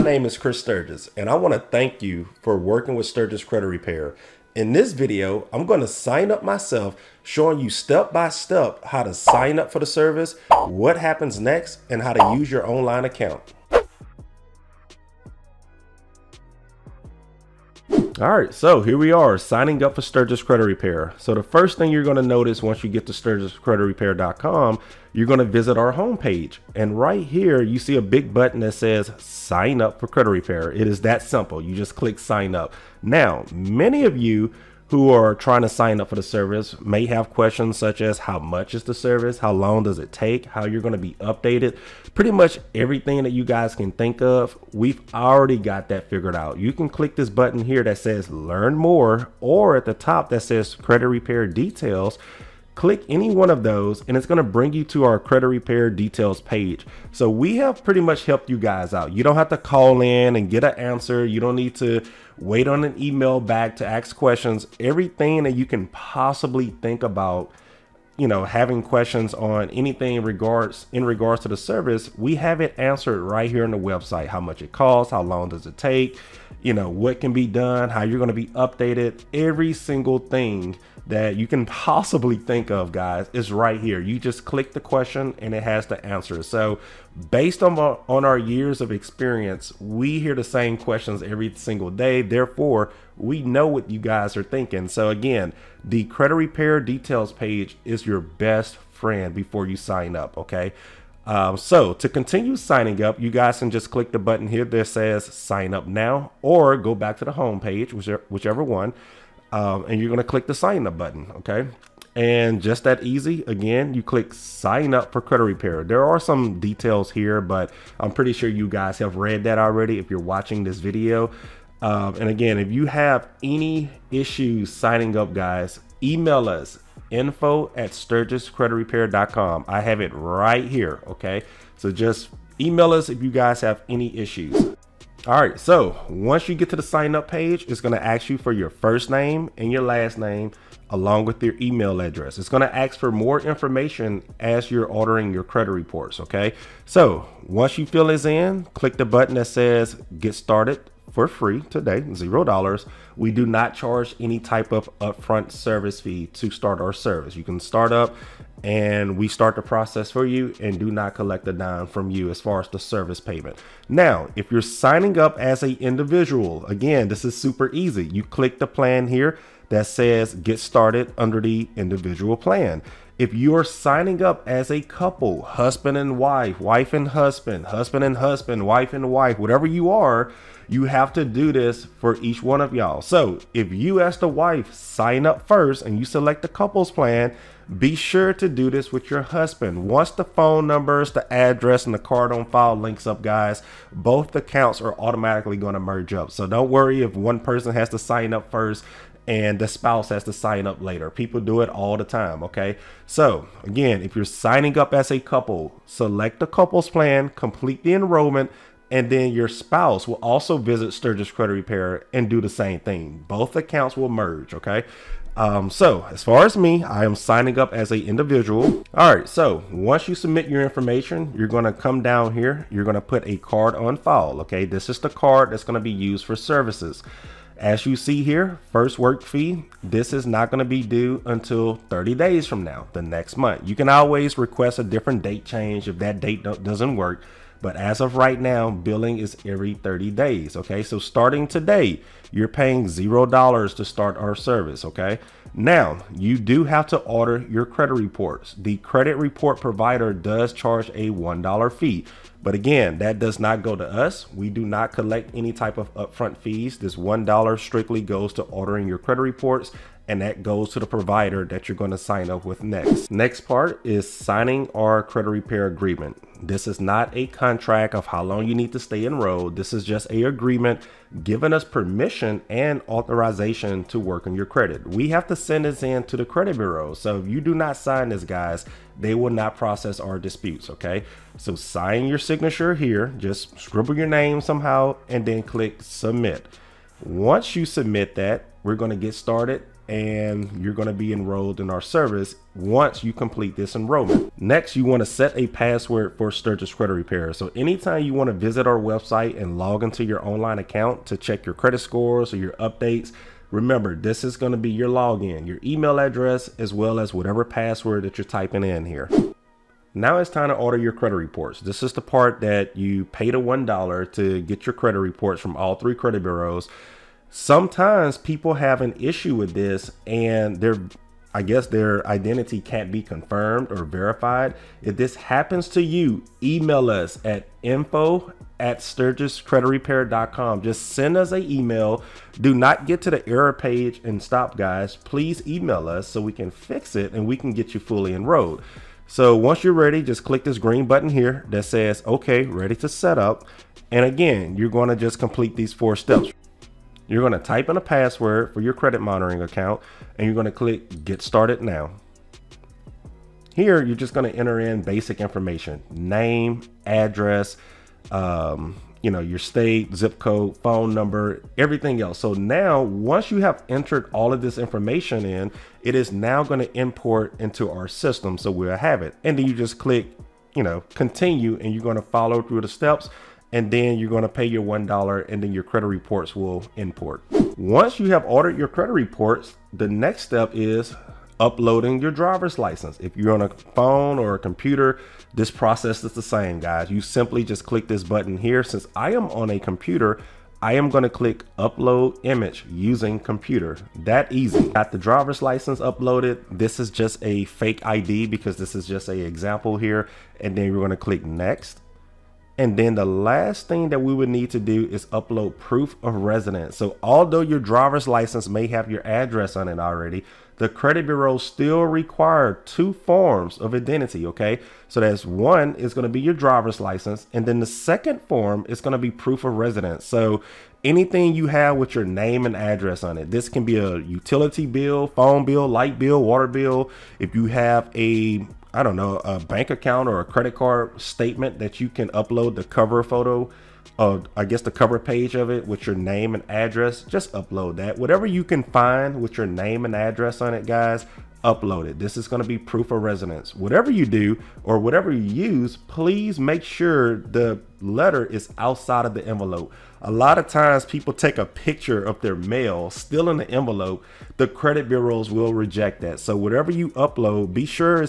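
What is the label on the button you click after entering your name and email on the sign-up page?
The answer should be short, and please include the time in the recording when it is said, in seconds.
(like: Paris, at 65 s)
Get started for free today, at 150 s.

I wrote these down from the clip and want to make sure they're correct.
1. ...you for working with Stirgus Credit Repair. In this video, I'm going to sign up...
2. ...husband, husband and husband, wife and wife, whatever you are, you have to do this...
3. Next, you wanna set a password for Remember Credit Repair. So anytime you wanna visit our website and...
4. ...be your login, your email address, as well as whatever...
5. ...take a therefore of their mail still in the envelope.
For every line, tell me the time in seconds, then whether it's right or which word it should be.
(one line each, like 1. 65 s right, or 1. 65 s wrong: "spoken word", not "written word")
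1. 2 s right
2. 177 s right
3. 294 s wrong: "Stirgus", not "Remember"
4. 304 s right
5. 451 s wrong: "picture", not "therefore".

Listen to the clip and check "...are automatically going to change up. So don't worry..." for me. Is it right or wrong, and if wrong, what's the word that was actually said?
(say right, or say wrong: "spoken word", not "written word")
wrong: "merge", not "change".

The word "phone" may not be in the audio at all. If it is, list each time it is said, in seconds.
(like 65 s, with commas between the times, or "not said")
190 s, 360 s, 383 s, 425 s.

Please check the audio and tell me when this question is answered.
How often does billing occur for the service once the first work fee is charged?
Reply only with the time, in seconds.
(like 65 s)
239 s.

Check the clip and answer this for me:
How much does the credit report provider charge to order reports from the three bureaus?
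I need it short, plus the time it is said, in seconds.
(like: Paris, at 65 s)
$1, at 251 s.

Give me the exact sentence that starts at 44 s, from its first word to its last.
We've already got that figured out.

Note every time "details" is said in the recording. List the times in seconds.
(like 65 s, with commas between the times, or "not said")
51 s, 55 s, 96 s, 116 s.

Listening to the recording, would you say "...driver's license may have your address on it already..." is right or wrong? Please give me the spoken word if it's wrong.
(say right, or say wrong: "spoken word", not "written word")
right.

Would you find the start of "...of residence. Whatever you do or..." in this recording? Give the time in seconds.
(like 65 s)
442 s.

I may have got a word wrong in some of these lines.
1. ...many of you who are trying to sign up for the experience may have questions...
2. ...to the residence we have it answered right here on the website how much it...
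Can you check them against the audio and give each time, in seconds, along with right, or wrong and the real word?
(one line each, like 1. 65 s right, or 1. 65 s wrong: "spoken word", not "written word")
1. 33 s wrong: "service", not "experience"
2. 71 s wrong: "service", not "residence".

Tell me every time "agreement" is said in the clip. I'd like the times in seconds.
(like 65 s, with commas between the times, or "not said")
265 s, 270 s.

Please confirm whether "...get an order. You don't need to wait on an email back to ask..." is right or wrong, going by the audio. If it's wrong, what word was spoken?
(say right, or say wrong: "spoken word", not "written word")
wrong: "answer", not "order".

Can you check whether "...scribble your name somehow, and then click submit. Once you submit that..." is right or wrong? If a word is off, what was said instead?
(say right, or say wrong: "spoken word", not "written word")
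right.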